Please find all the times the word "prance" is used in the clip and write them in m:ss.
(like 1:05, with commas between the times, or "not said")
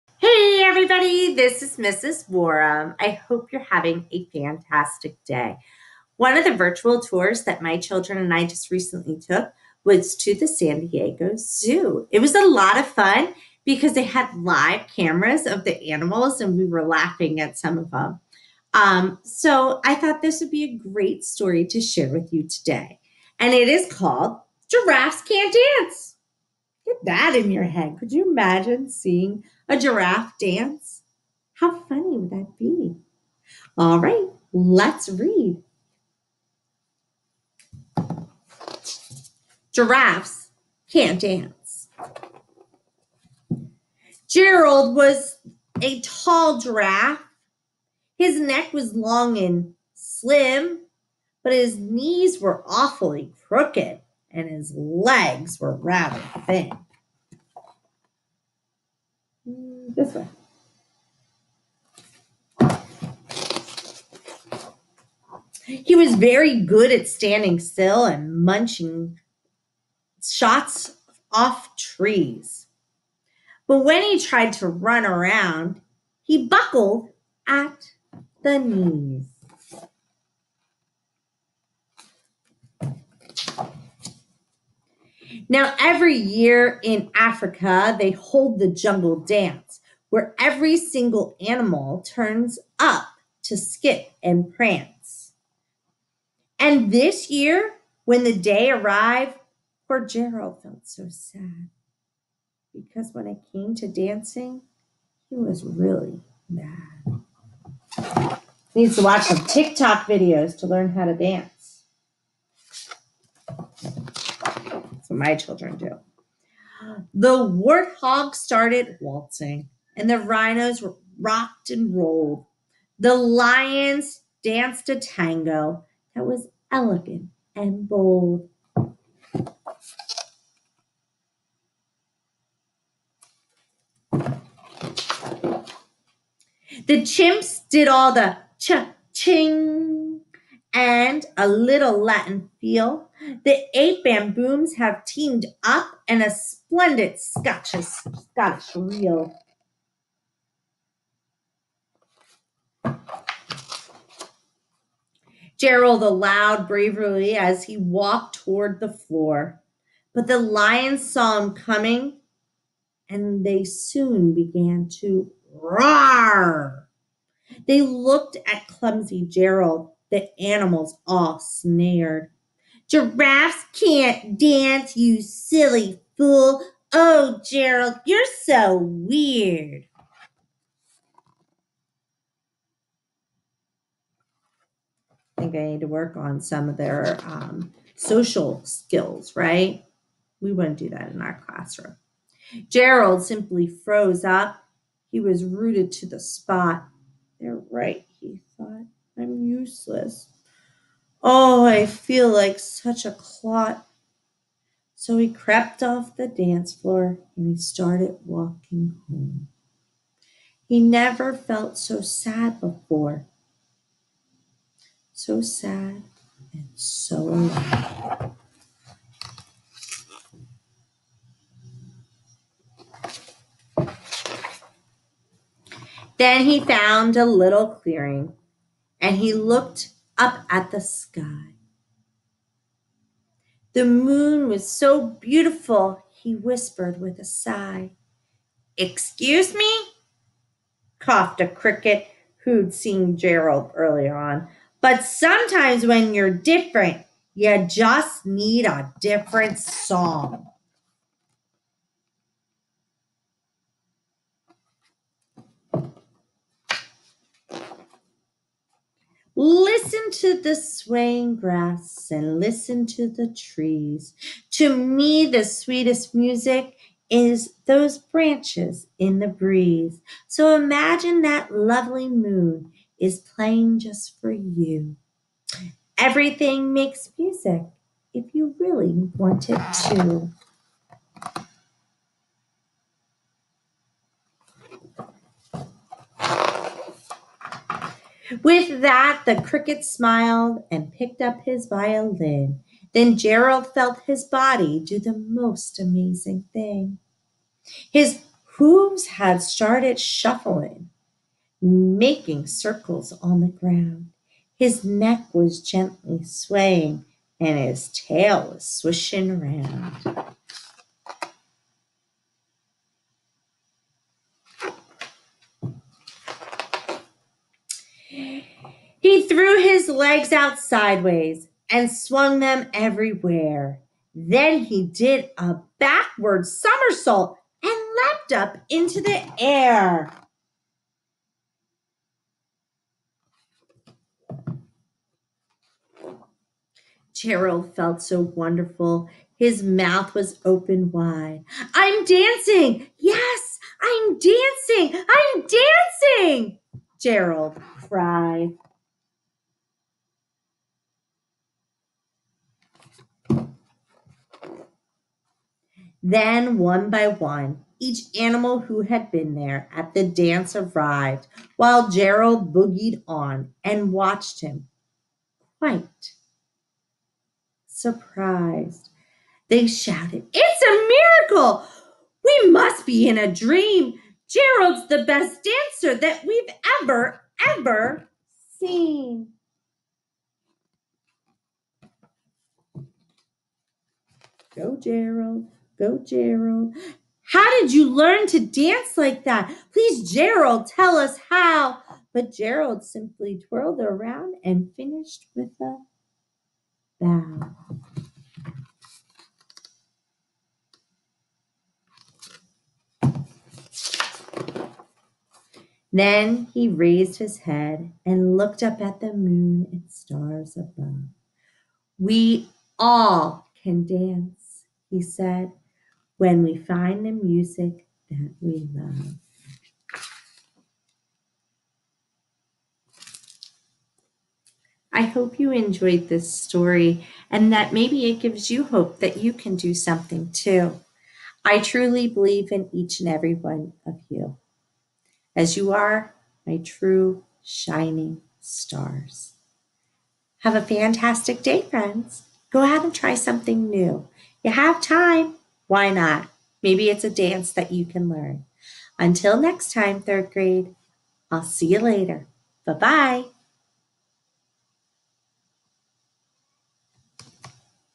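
1:34.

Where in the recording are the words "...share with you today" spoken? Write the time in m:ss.
0:21.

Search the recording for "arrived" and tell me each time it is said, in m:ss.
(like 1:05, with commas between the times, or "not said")
1:38, 6:00.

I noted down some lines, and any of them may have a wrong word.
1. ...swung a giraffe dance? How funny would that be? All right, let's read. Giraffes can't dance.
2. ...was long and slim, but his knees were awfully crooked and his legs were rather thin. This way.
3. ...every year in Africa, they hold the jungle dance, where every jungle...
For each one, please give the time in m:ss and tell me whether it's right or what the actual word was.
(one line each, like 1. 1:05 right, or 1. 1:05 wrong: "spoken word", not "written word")
1. 0:28 wrong: "seeing", not "swung"
2. 0:48 right
3. 1:25 wrong: "single", not "jungle".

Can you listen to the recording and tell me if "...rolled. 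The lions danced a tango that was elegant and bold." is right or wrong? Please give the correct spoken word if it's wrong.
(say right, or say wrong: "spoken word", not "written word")
right.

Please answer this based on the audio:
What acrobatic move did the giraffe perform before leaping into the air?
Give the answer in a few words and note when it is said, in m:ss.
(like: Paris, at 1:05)
backward somersault, at 5:25.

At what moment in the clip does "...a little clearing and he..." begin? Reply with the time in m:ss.
3:47.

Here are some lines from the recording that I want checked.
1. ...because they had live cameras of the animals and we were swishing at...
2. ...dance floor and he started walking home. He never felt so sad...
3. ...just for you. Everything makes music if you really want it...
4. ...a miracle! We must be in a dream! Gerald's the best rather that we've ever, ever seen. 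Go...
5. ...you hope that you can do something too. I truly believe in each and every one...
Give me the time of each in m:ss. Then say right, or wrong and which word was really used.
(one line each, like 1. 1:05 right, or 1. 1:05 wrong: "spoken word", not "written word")
1. 0:13 wrong: "laughing", not "swishing"
2. 3:26 right
3. 4:33 right
4. 6:10 wrong: "dancer", not "rather"
5. 7:08 right.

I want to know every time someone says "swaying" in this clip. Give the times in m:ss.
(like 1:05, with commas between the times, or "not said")
4:20, 5:06.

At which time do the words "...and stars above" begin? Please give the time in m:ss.
6:49.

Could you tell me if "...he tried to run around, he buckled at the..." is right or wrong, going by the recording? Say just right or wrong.
right.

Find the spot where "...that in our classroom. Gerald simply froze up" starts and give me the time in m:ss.
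3:10.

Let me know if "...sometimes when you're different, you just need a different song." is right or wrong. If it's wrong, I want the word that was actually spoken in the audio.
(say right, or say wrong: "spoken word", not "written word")
right.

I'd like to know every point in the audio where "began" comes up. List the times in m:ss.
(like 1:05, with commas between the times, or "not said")
2:44.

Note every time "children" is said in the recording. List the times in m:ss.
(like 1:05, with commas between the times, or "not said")
0:07, 1:55.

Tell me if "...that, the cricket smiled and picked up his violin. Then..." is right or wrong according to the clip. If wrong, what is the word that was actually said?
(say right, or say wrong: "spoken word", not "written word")
right.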